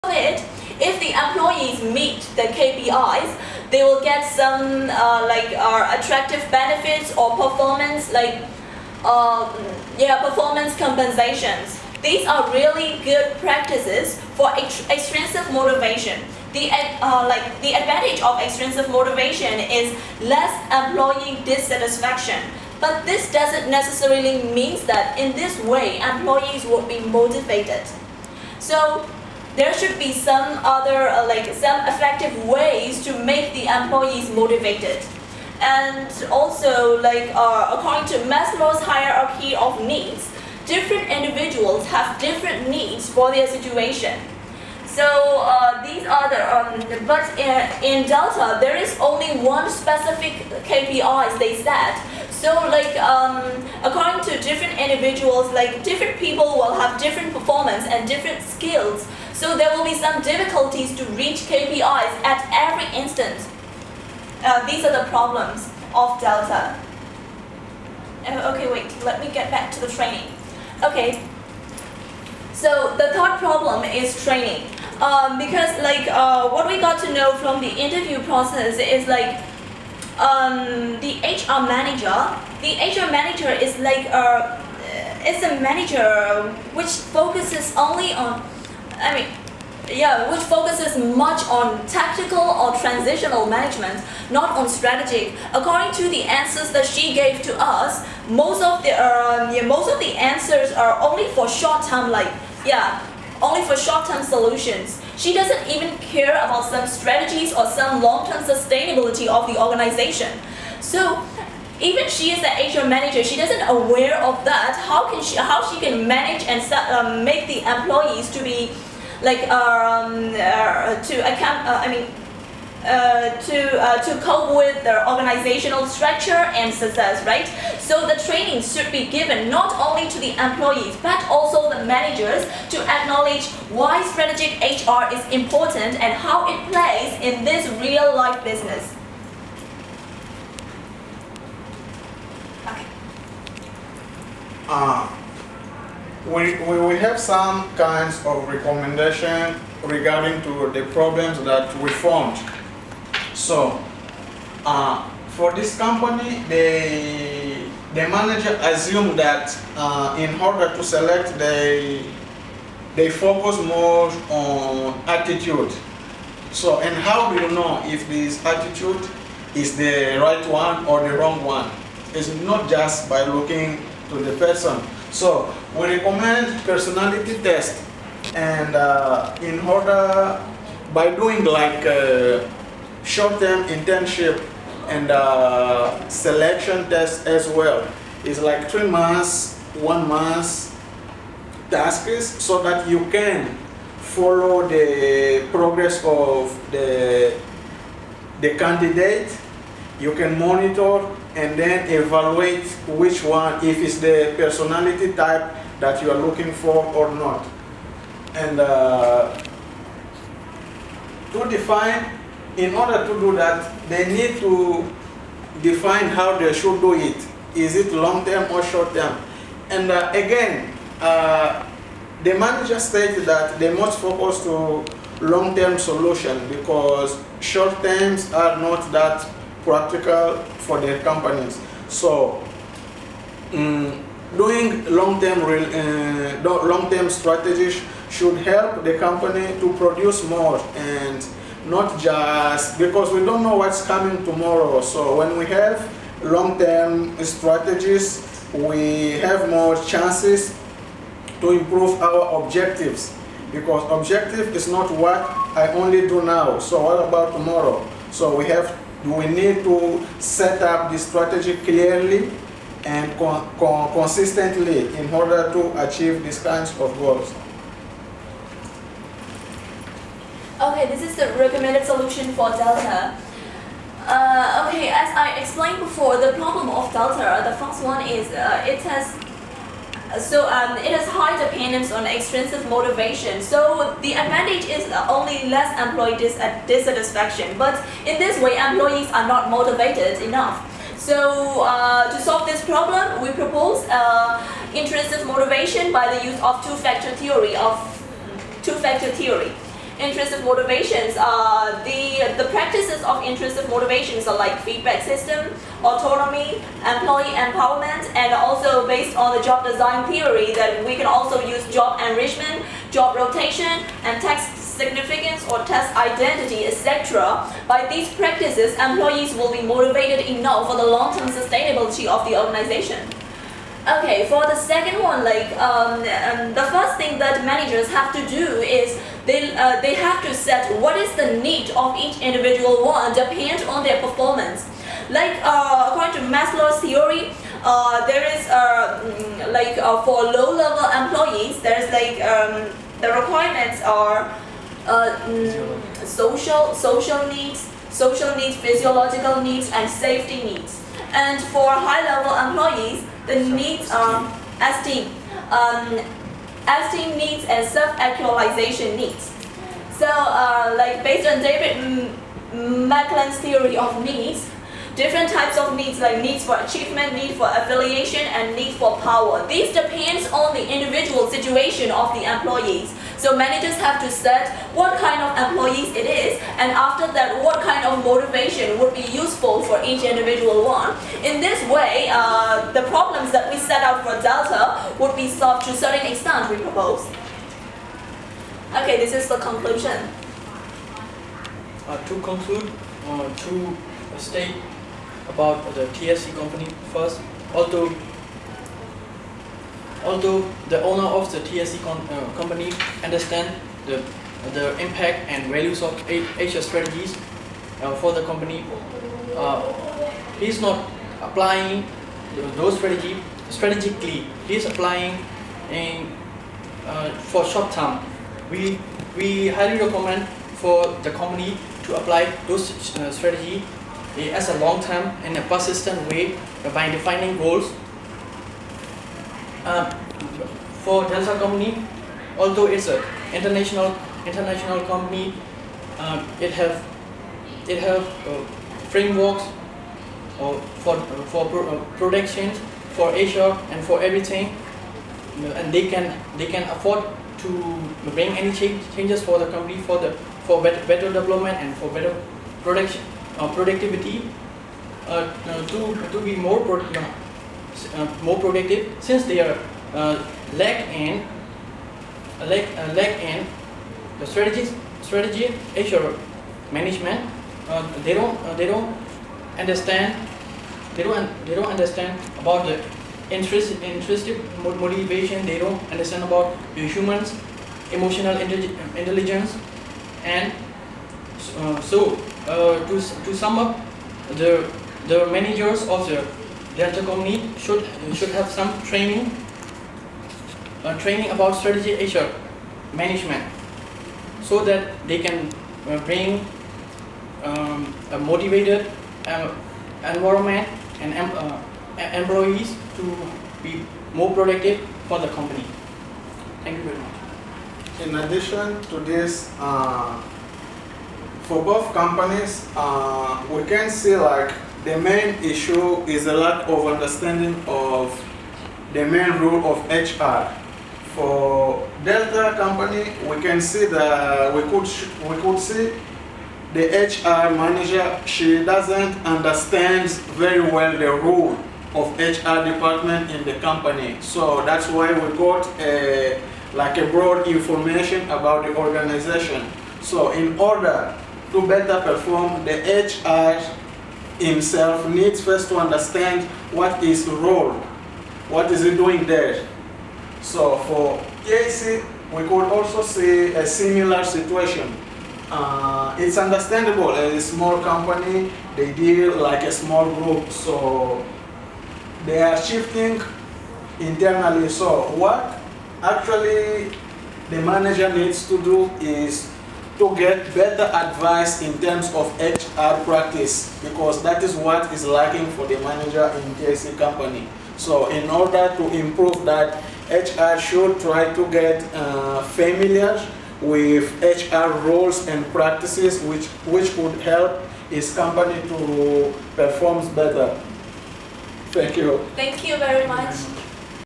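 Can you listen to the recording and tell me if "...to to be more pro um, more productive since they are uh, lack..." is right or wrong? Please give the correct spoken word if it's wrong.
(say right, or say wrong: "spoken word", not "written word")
right.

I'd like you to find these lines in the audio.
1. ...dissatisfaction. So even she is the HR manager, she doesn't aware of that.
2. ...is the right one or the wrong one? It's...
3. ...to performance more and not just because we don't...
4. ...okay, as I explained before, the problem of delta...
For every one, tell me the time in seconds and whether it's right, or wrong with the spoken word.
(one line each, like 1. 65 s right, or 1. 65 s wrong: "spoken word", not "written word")
1. 109 s wrong: "organization", not "dissatisfaction"
2. 169 s right
3. 239 s wrong: "produce", not "performance"
4. 274 s right.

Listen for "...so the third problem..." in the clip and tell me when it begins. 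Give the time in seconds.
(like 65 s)
72 s.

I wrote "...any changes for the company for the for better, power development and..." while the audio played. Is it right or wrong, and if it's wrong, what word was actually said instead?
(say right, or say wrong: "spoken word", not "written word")
wrong: "better", not "power".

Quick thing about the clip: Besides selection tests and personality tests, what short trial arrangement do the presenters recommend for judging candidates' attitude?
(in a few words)
Short-term internship.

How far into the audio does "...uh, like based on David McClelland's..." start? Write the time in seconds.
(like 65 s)
360 s.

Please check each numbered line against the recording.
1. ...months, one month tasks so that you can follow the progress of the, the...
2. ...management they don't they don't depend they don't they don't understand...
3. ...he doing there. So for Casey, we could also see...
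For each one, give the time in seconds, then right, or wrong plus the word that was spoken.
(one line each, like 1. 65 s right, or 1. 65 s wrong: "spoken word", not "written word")
1. 188 s right
2. 466 s wrong: "understand", not "depend"
3. 548 s right.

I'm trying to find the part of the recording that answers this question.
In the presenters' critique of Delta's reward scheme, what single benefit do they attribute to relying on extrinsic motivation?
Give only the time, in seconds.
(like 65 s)
20 s.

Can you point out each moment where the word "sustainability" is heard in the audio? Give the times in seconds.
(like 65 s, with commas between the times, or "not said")
108 s, 321 s.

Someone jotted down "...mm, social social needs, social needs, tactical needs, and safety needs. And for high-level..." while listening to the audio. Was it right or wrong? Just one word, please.
wrong.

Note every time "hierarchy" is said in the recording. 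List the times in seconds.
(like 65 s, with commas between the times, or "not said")
38 s.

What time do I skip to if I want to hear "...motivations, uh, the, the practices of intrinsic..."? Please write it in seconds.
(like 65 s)
300 s.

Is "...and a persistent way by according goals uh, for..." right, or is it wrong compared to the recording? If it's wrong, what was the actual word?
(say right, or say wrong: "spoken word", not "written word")
wrong: "defining", not "according".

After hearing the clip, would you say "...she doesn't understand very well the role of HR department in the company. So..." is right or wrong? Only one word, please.
right.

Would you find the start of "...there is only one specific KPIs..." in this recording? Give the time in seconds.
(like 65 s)
48 s.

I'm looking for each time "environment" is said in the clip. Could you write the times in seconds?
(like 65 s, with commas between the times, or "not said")
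500 s.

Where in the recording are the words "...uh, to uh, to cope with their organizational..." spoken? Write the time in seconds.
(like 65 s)
122 s.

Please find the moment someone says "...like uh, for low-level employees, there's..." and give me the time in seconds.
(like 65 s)
339 s.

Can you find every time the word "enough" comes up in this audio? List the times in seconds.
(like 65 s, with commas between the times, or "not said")
290 s, 320 s.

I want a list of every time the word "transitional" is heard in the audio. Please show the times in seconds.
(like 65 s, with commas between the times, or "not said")
92 s.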